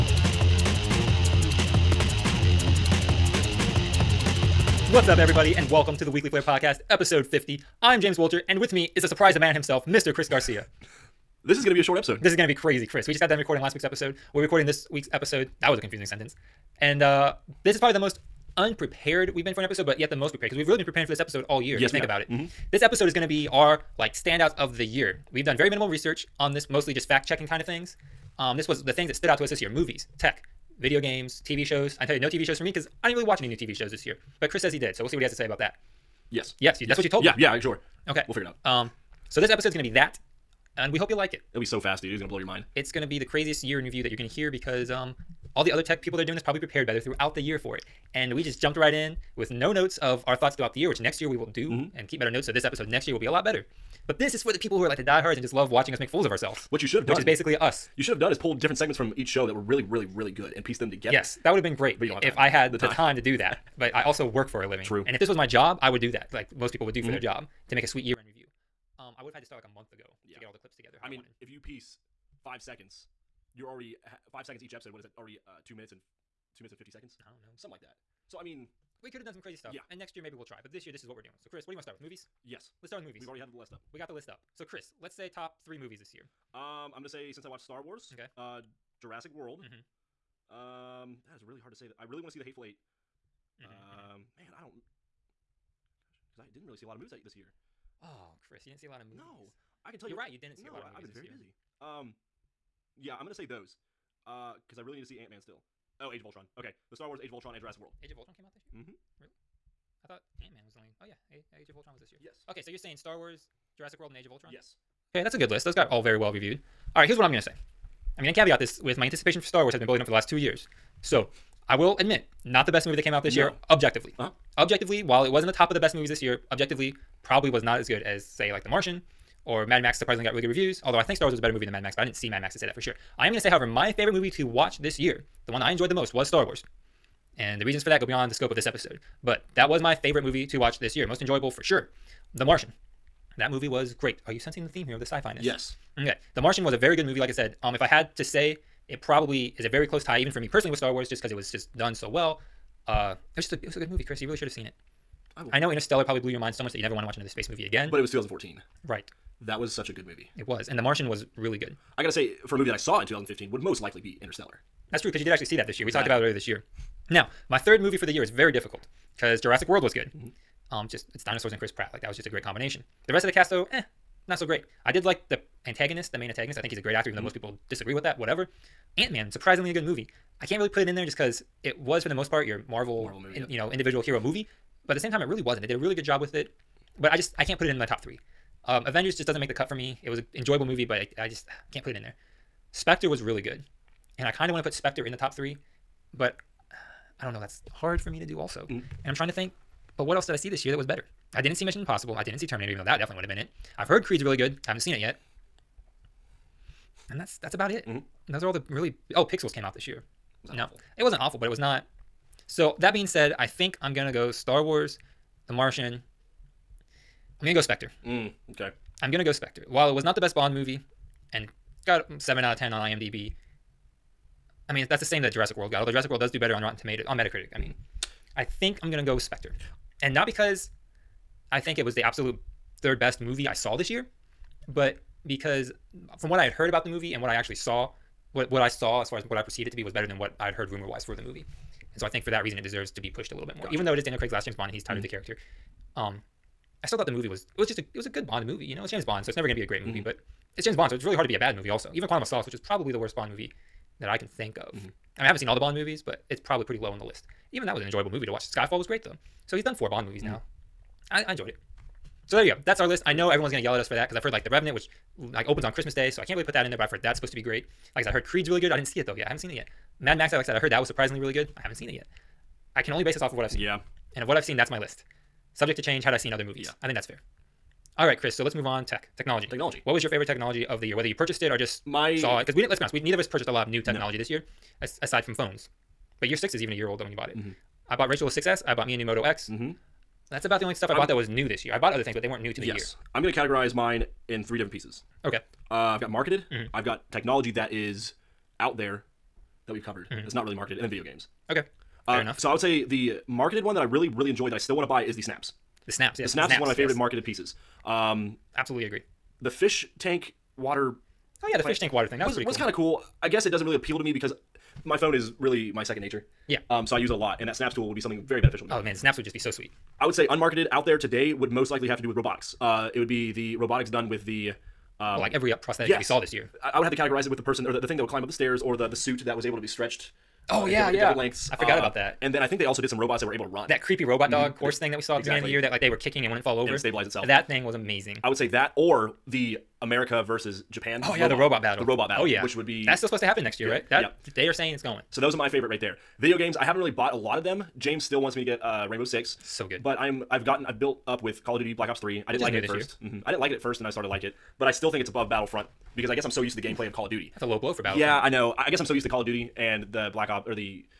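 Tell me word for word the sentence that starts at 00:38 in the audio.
Um, so this episode's gonna be that, and we hope you like it.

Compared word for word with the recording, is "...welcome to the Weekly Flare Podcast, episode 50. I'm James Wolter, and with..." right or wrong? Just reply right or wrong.
right.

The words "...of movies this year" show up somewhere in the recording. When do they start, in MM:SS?
01:36.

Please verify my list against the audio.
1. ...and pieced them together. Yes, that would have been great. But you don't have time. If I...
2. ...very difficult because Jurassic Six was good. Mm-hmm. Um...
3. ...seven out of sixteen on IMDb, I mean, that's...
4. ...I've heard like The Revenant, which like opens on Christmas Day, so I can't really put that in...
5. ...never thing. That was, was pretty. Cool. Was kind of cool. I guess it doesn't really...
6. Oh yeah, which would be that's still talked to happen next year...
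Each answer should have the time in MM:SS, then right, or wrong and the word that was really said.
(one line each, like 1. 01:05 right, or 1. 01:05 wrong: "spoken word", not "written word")
1. 01:00 right
2. 02:48 wrong: "World", not "Six"
3. 03:42 wrong: "ten", not "sixteen"
4. 04:24 right
5. 05:11 wrong: "water", not "never"
6. 05:42 wrong: "supposed", not "talked".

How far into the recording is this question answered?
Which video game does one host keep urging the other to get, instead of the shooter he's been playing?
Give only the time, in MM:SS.
05:48.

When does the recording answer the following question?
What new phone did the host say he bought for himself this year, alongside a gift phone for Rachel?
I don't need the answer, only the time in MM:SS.
04:49.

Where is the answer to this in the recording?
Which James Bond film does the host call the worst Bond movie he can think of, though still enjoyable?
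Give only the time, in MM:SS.
04:12.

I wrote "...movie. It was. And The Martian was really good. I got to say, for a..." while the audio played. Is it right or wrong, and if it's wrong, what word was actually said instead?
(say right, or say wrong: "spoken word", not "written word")
right.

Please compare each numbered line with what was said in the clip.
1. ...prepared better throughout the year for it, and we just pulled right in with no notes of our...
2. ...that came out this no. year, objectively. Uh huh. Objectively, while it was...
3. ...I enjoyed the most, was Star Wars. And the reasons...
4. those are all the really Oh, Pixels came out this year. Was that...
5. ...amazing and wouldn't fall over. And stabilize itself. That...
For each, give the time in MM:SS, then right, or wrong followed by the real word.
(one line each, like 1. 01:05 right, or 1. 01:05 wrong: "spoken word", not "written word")
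1. 00:46 wrong: "jumped", not "pulled"
2. 02:02 right
3. 02:15 right
4. 03:28 right
5. 05:35 wrong: "kicking", not "amazing".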